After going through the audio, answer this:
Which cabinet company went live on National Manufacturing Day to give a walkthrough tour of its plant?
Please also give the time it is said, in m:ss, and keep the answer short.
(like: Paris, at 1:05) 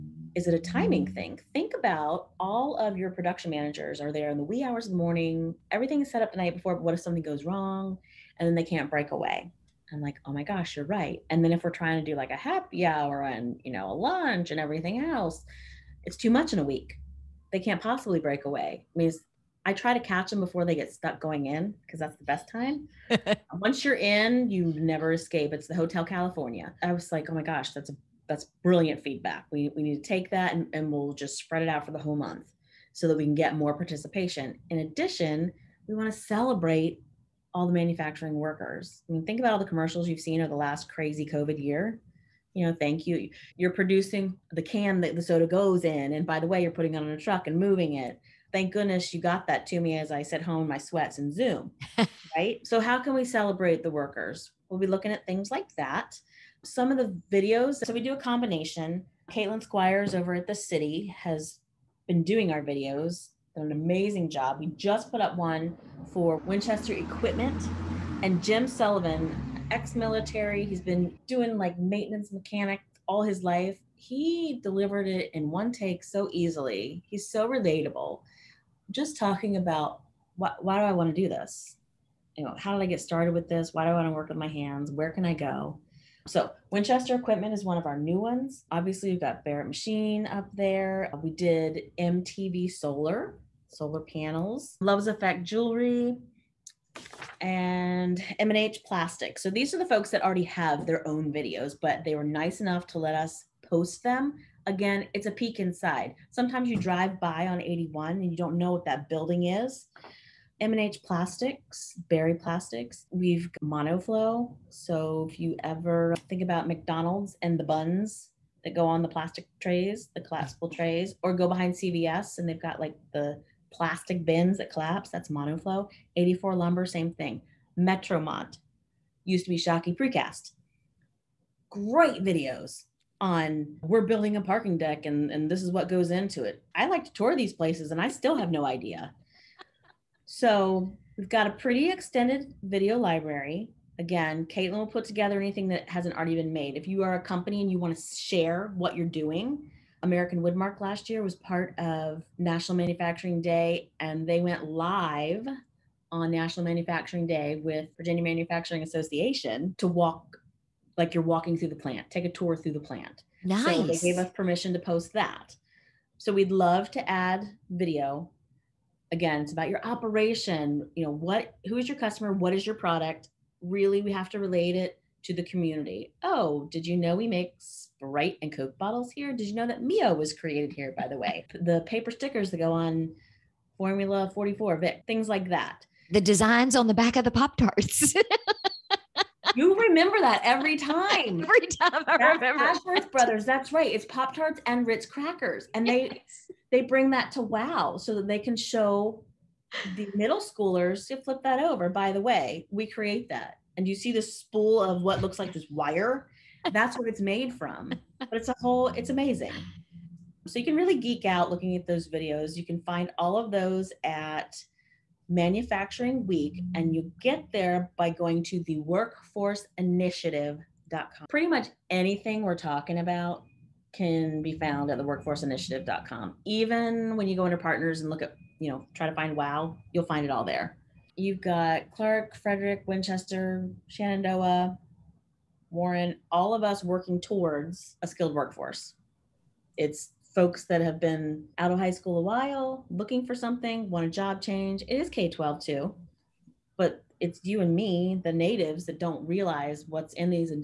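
American Woodmark, at 2:30.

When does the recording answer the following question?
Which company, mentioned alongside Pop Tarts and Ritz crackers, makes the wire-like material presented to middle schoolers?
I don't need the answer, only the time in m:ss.
3:12.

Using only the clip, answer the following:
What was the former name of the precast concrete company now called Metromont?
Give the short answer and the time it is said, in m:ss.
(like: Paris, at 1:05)
Shockey Precast, at 2:09.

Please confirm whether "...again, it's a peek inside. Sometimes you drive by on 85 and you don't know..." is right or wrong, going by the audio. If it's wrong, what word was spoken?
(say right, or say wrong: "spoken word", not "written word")
wrong: "81", not "85".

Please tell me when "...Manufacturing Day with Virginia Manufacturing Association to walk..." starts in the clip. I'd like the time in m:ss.
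2:36.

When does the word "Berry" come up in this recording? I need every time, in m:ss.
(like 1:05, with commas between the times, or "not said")
1:52.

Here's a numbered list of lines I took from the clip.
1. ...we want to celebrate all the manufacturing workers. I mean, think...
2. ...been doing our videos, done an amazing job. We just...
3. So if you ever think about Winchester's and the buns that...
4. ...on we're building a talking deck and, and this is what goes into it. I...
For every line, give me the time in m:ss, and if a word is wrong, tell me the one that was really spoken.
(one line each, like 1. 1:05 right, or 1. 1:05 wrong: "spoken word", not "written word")
1. 0:35 right
2. 1:02 right
3. 1:54 wrong: "McDonald", not "Winchester"
4. 2:13 wrong: "parking", not "talking".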